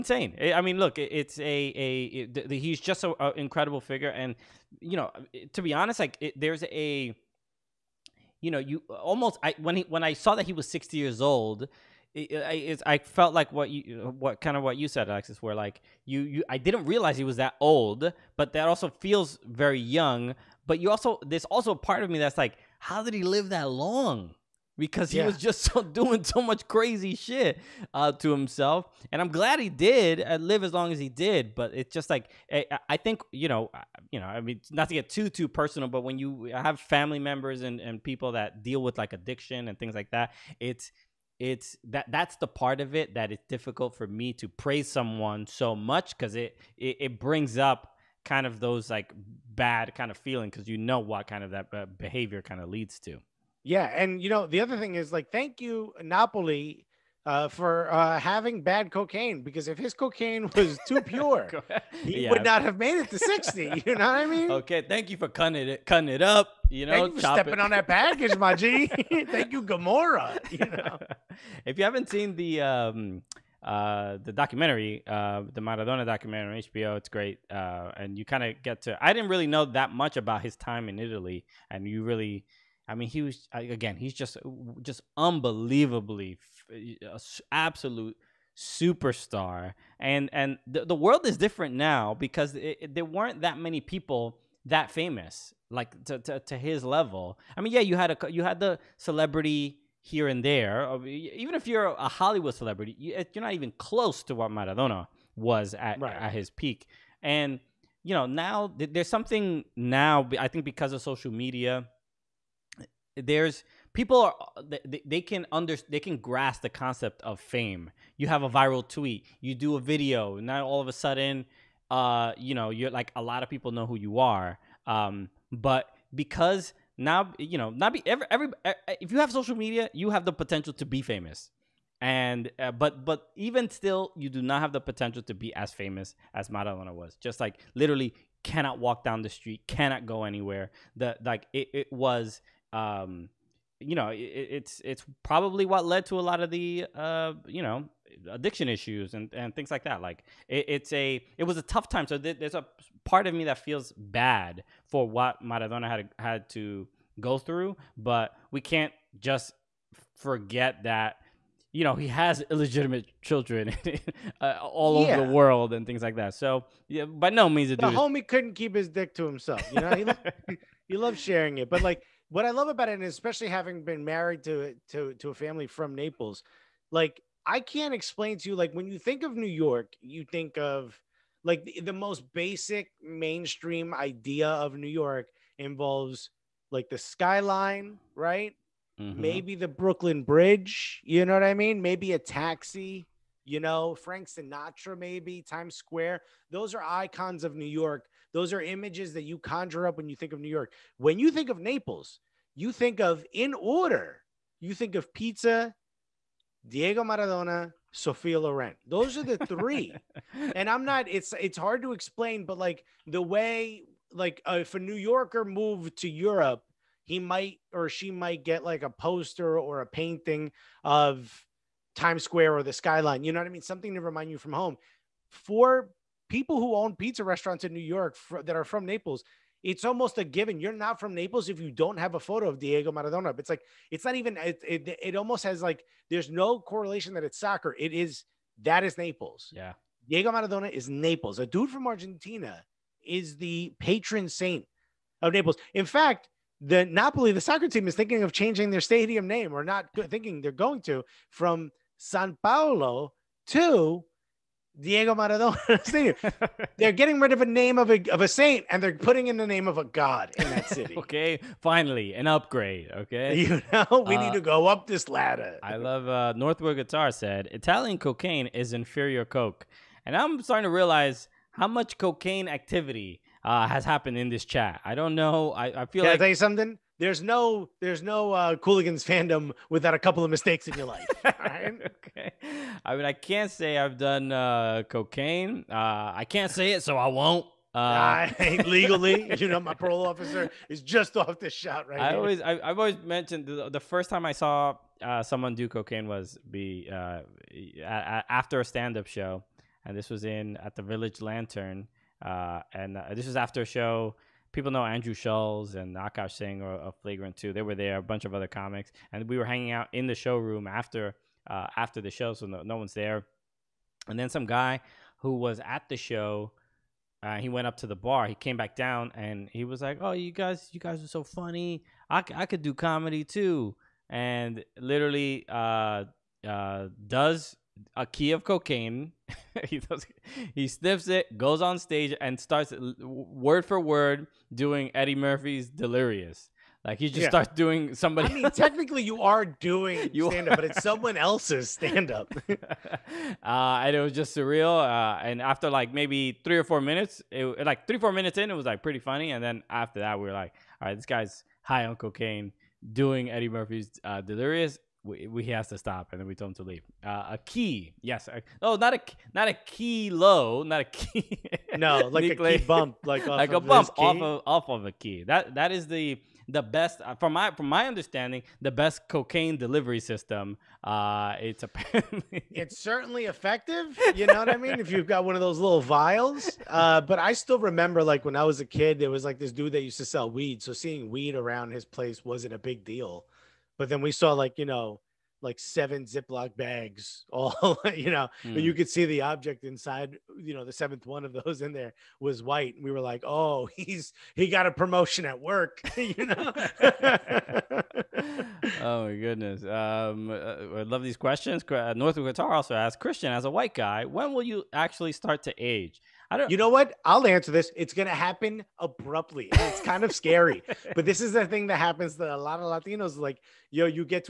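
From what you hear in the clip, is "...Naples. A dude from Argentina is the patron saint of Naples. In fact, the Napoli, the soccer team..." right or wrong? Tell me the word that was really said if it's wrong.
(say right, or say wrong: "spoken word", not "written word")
right.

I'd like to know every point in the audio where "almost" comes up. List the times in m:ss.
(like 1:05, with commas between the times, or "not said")
0:08, 3:49, 3:55.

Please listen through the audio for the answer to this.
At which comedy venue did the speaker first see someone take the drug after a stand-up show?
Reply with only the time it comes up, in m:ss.
5:00.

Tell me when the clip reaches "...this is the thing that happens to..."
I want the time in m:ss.
6:51.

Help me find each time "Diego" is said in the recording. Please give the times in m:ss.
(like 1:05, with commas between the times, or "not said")
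3:26, 3:52, 4:00, 4:14.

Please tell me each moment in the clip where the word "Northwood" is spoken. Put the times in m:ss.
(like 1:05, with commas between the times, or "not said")
4:26, 6:41.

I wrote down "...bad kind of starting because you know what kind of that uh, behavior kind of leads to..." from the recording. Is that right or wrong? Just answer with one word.
wrong.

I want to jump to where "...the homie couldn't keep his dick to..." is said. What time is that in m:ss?
2:47.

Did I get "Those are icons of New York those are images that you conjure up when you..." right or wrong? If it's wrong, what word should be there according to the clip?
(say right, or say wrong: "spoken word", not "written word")
right.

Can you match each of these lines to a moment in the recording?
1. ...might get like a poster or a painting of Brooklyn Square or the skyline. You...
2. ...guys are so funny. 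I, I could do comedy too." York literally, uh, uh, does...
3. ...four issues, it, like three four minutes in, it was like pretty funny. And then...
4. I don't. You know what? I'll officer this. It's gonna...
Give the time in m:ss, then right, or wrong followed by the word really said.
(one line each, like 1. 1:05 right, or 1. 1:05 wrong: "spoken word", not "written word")
1. 3:38 wrong: "Times", not "Brooklyn"
2. 5:20 wrong: "And", not "York"
3. 5:46 wrong: "minutes", not "issues"
4. 6:46 wrong: "answer", not "officer".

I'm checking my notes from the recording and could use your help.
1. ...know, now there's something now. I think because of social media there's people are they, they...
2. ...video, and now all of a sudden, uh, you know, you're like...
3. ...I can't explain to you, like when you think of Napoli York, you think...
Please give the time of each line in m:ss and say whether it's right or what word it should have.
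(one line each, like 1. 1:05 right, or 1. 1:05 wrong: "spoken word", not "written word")
1. 1:48 right
2. 1:59 right
3. 2:57 wrong: "New", not "Napoli".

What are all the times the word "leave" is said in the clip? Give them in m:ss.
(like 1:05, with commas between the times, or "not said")
5:56.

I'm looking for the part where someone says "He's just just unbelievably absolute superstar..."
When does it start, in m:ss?
1:23.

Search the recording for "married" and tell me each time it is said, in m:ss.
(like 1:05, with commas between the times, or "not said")
2:54.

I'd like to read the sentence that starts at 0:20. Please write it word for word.
But you also there's also a part of me that's like, how did he live that long?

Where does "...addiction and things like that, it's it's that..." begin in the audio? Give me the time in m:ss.
0:39.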